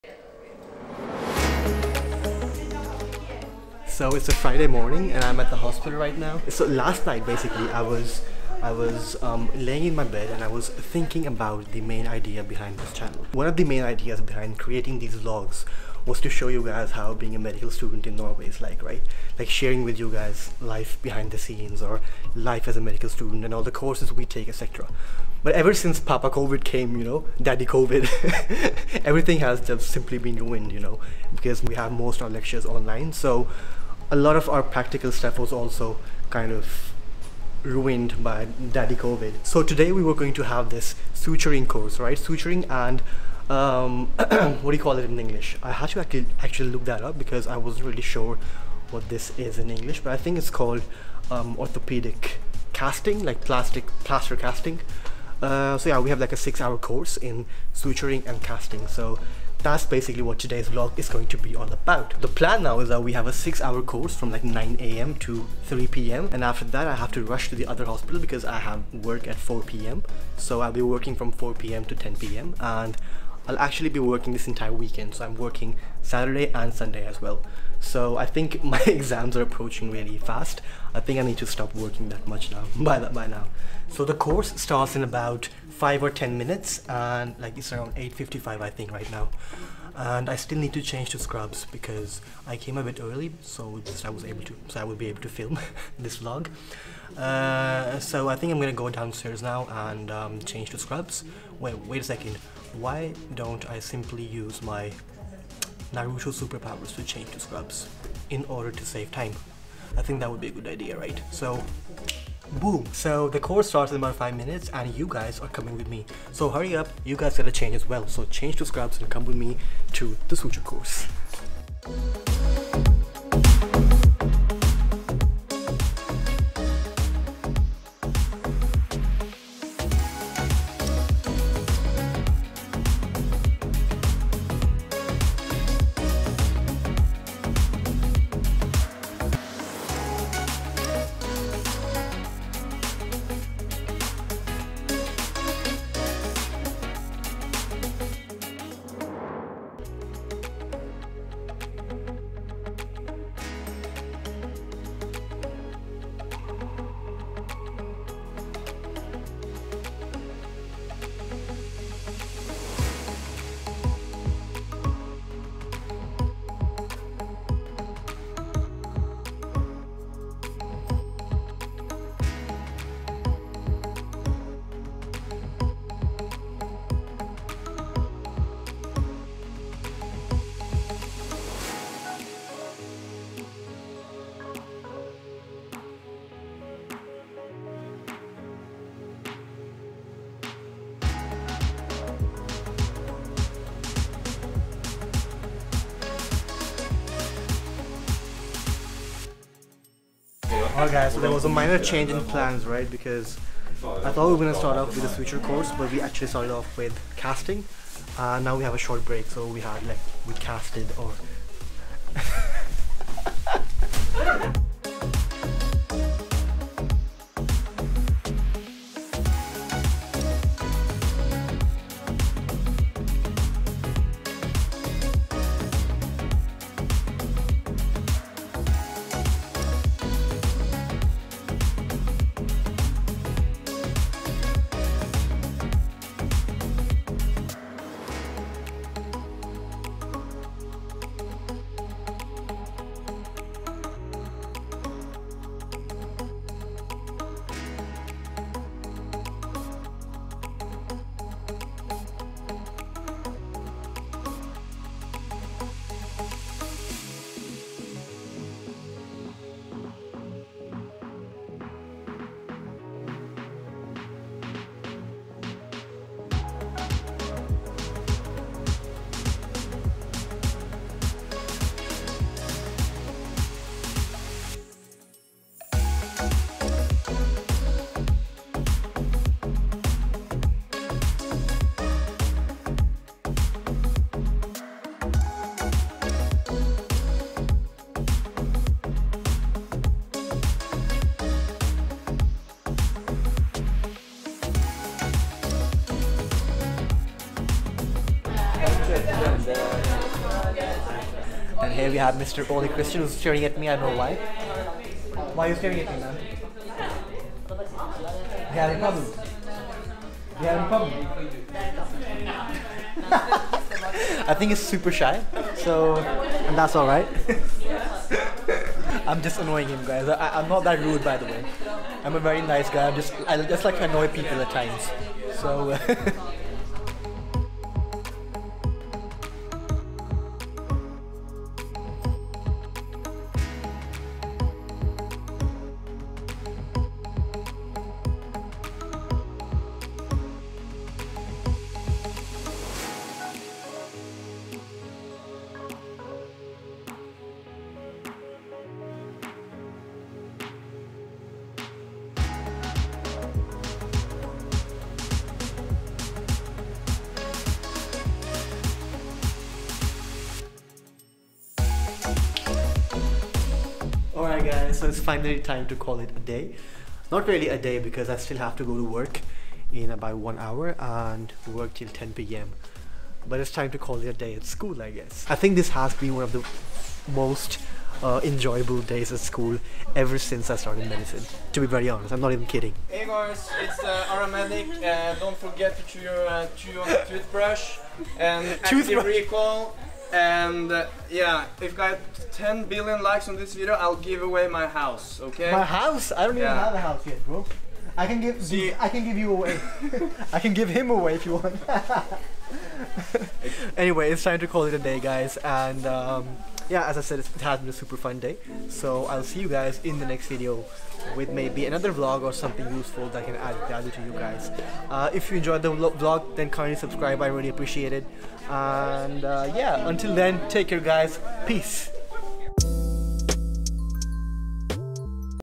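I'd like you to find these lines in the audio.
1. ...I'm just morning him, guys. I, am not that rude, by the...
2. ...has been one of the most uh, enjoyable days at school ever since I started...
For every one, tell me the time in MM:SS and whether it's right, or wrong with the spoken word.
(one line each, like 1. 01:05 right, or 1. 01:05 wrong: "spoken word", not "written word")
1. 05:19 wrong: "annoying", not "morning"
2. 06:15 right.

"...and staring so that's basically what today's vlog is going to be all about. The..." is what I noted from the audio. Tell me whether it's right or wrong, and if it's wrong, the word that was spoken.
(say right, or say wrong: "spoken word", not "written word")
wrong: "casting", not "staring".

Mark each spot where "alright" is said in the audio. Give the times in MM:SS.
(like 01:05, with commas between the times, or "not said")
03:20, 05:16.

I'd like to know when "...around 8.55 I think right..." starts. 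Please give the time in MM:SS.
01:27.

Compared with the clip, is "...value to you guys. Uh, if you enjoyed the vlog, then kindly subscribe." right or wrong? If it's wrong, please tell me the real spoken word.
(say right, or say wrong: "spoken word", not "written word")
right.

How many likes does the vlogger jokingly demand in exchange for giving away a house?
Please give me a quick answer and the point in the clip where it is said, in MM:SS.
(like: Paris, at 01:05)
10 billion, at 06:32.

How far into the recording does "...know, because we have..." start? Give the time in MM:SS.
00:30.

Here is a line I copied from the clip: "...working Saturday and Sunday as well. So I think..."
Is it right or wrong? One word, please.
right.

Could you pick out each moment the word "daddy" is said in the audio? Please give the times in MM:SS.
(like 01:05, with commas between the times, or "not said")
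00:27, 00:38.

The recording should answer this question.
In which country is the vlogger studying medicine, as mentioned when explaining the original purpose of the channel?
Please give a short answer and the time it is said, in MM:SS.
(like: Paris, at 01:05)
Norway, at 00:18.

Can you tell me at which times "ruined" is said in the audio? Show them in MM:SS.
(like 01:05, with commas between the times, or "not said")
00:30, 00:37.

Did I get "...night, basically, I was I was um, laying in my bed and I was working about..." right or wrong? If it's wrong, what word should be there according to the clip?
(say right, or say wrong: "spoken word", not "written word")
wrong: "thinking", not "working".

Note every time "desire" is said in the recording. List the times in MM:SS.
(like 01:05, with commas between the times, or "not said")
not said.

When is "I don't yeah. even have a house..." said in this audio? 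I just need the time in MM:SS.
06:36.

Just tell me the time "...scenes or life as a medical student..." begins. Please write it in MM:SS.
00:21.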